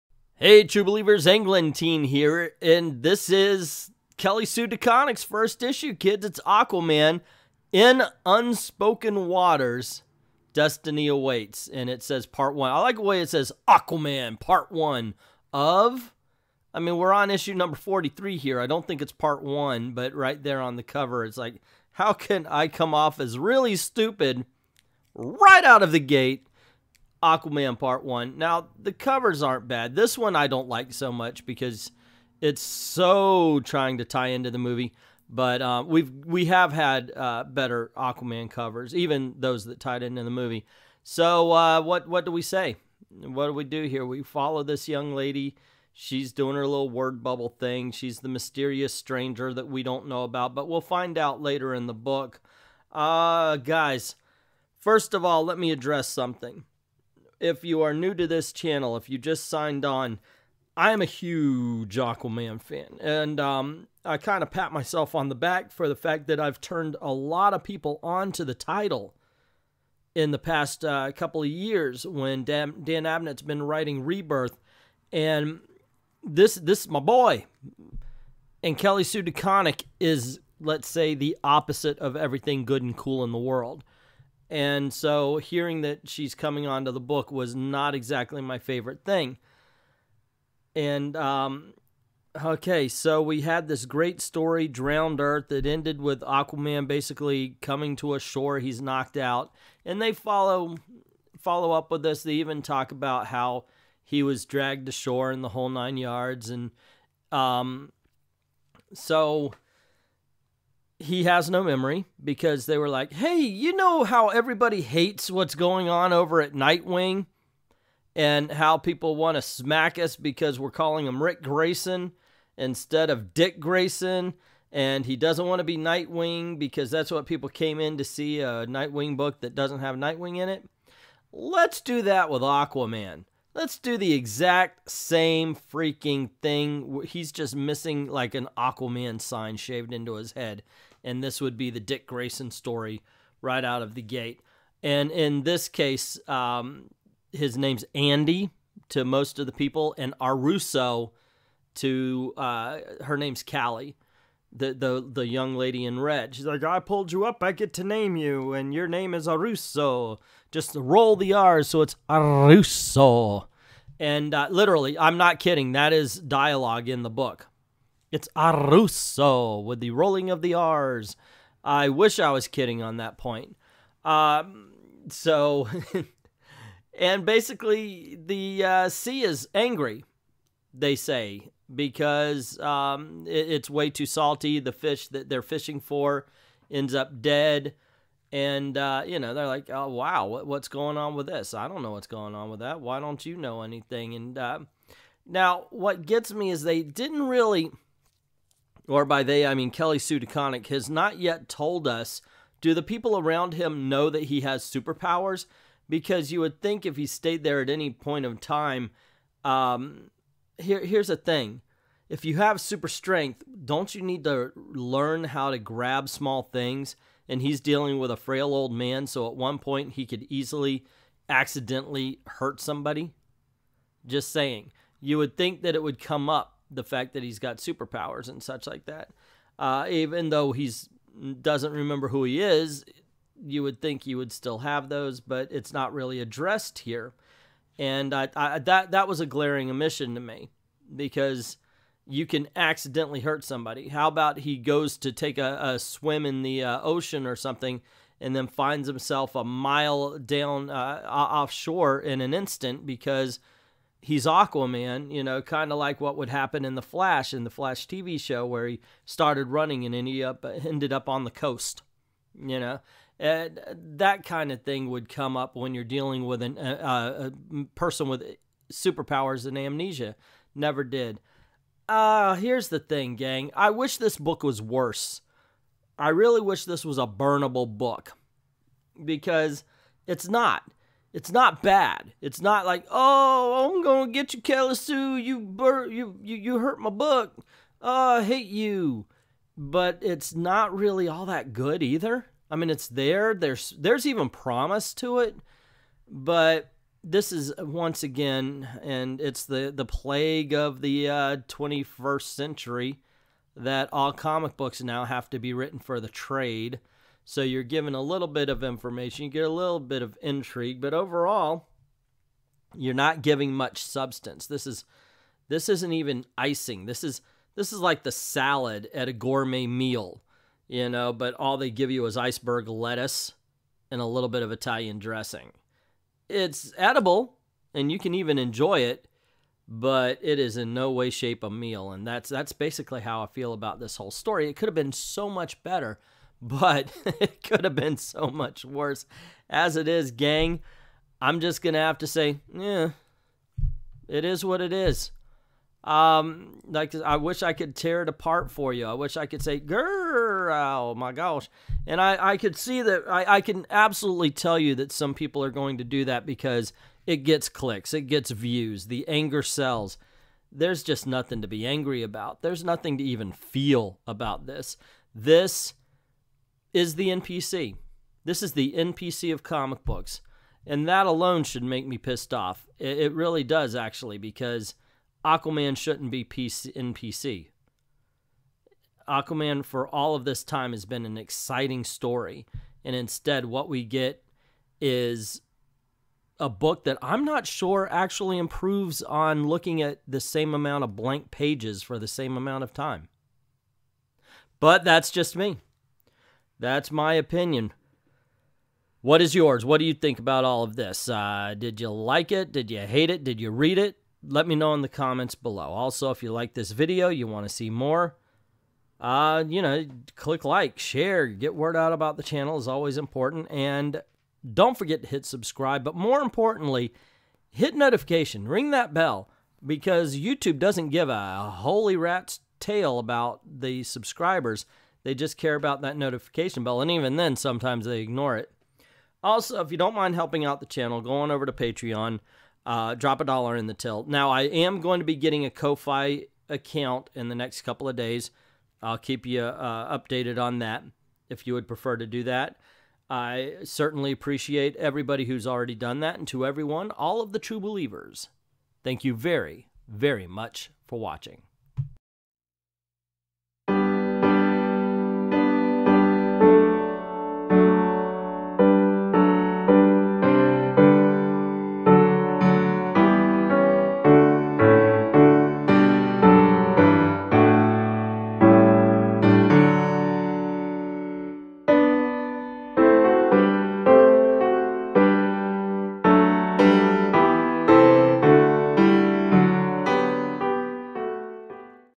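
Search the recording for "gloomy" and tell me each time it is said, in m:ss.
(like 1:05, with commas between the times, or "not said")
not said.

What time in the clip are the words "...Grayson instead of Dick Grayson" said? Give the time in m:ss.
2:01.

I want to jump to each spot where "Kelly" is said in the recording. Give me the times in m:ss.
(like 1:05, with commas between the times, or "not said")
0:04, 1:18, 3:19, 4:44.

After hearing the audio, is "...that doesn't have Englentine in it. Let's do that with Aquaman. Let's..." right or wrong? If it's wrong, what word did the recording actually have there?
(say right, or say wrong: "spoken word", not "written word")
wrong: "Nightwing", not "Englentine".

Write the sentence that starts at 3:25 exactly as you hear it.
Because you would think if he stayed there at any point of time, um, here, here's the thing.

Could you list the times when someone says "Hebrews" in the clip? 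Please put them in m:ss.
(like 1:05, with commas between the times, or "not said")
not said.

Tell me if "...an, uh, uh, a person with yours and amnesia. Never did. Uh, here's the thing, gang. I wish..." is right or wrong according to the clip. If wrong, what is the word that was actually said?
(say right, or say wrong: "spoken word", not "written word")
wrong: "superpowers", not "yours".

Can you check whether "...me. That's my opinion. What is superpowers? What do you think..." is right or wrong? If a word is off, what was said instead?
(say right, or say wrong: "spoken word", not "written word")
wrong: "yours", not "superpowers".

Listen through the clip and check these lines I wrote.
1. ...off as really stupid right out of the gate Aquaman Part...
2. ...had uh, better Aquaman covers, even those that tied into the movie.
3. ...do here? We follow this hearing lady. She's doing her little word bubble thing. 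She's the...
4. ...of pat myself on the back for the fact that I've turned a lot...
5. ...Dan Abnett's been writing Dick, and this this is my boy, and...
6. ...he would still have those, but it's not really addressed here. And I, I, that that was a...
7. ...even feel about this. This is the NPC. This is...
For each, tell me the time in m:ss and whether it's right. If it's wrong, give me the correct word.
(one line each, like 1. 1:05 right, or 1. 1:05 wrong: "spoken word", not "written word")
1. 0:22 right
2. 0:36 right
3. 0:43 wrong: "young", not "hearing"
4. 1:04 right
5. 1:12 wrong: "Rebirth", not "Dick"
6. 3:54 right
7. 6:03 right.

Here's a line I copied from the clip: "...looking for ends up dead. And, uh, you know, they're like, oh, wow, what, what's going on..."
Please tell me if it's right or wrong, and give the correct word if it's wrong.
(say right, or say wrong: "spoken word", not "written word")
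wrong: "fishing", not "looking".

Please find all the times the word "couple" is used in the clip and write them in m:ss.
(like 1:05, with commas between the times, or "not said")
1:11, 7:17.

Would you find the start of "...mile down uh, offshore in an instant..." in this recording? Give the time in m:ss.
4:09.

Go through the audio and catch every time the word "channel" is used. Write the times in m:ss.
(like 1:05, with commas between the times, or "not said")
0:58, 6:52, 7:10.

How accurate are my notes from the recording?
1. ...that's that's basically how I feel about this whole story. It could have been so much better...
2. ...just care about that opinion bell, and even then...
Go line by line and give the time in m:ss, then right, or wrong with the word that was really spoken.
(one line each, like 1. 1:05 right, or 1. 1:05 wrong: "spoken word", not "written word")
1. 5:32 right
2. 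7:05 wrong: "notification", not "opinion".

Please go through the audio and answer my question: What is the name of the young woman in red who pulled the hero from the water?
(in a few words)
Callie.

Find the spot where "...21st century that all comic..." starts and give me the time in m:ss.
5:01.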